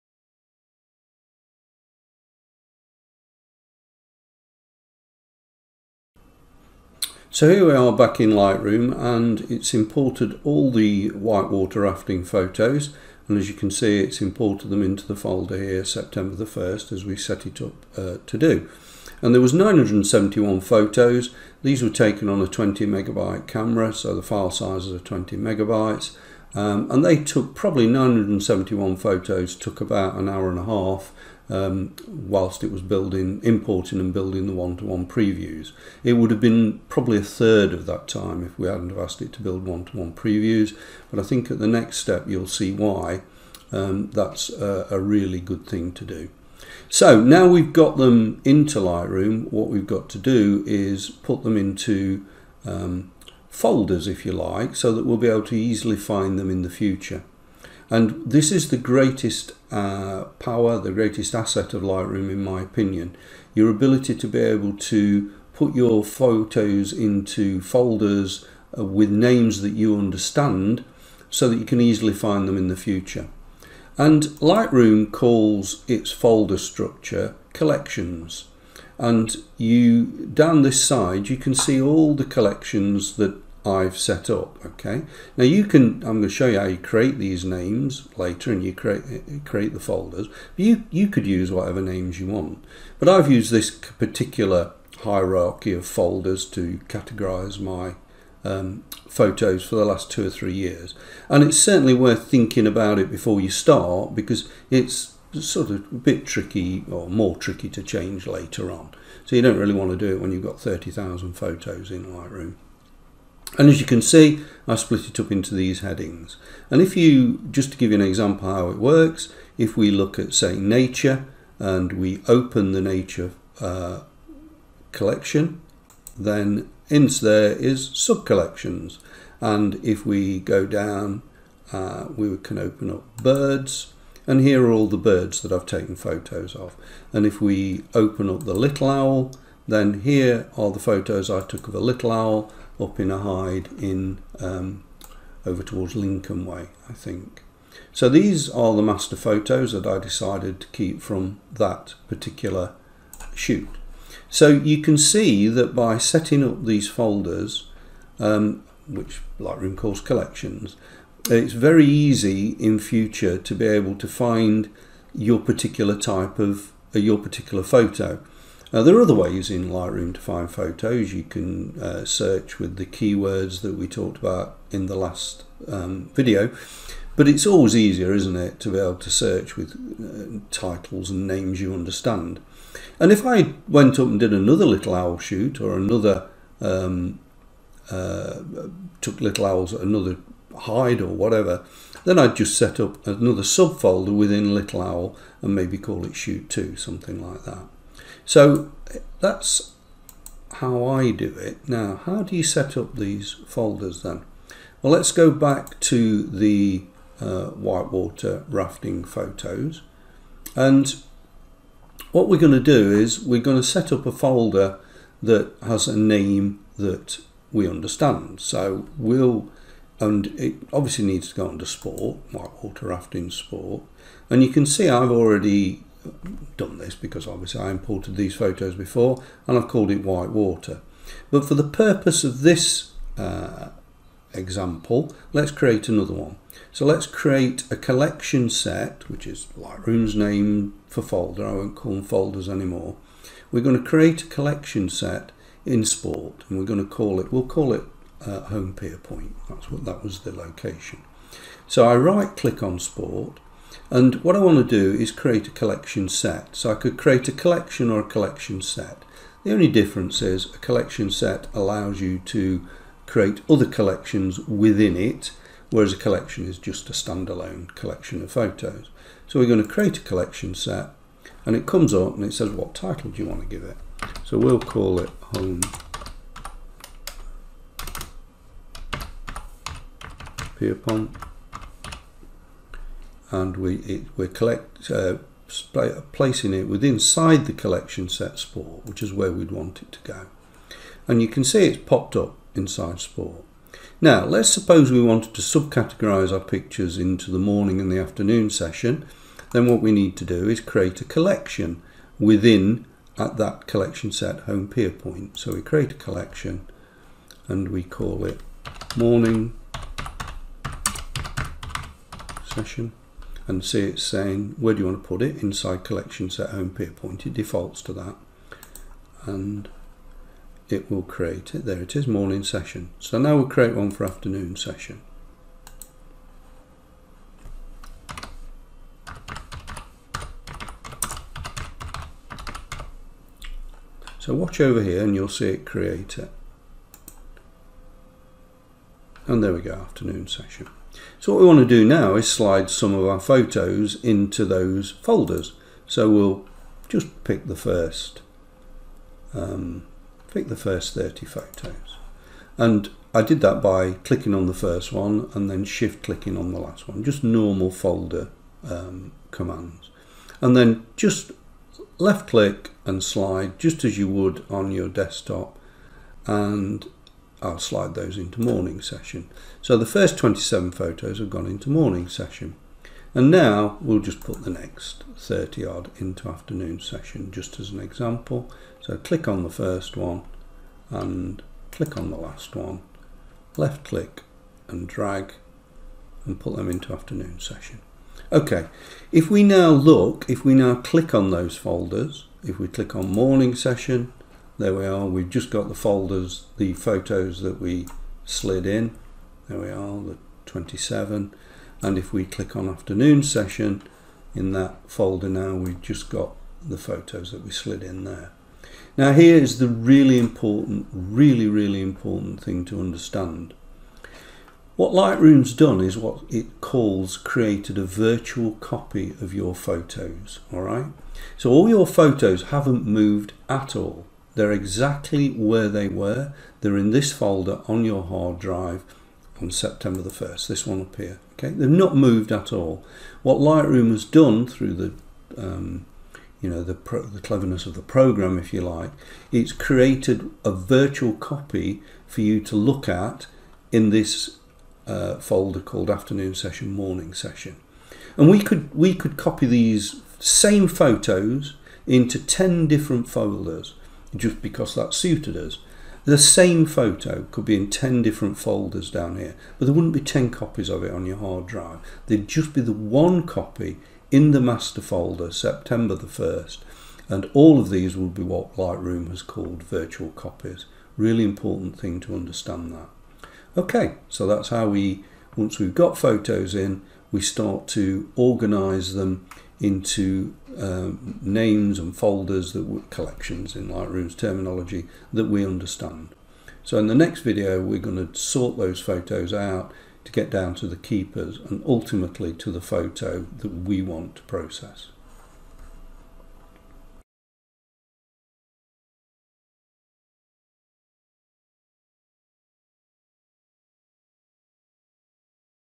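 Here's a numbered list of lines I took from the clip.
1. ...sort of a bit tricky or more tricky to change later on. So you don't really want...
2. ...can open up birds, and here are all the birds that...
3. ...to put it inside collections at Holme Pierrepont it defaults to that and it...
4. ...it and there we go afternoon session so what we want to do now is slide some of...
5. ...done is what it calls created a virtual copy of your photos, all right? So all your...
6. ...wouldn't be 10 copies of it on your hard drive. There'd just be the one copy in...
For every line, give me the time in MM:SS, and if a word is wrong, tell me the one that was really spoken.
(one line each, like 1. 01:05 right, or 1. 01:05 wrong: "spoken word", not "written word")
1. 01:45 right
2. 02:12 right
3. 05:15 right
4. 05:36 right
5. 06:55 right
6. 07:39 right.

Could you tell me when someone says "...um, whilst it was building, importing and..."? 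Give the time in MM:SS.
00:31.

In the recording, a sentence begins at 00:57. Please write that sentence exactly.
And this is the greatest uh, power, the greatest asset of Lightroom, in my opinion.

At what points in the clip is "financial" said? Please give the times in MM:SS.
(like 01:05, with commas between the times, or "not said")
not said.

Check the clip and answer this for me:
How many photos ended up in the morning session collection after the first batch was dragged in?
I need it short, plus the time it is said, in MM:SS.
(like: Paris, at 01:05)
27, at 06:10.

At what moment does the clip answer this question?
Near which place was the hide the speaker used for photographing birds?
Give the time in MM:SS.
02:25.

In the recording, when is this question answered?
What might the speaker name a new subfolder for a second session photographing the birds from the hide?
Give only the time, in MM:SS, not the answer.
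03:16.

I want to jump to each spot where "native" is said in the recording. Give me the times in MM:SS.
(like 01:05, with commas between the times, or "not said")
not said.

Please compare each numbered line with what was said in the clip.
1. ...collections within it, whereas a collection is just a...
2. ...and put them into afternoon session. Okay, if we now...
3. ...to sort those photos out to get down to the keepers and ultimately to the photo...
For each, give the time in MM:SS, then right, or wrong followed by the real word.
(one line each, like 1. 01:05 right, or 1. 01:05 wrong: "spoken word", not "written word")
1. 04:23 right
2. 06:26 right
3. 08:08 right.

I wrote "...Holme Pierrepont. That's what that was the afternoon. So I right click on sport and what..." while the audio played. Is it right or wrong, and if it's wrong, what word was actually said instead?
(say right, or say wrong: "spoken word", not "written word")
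wrong: "location", not "afternoon".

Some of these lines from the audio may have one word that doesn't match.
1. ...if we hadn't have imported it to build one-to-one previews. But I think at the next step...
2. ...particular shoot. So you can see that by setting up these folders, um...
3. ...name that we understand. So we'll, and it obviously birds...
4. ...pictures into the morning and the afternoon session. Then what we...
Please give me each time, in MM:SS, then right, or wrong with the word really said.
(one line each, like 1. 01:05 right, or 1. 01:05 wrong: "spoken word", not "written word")
1. 00:38 wrong: "asked", not "imported"
2. 02:32 right
3. 03:35 wrong: "needs", not "birds"
4. 04:56 right.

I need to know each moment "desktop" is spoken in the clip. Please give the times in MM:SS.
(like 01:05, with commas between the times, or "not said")
06:04.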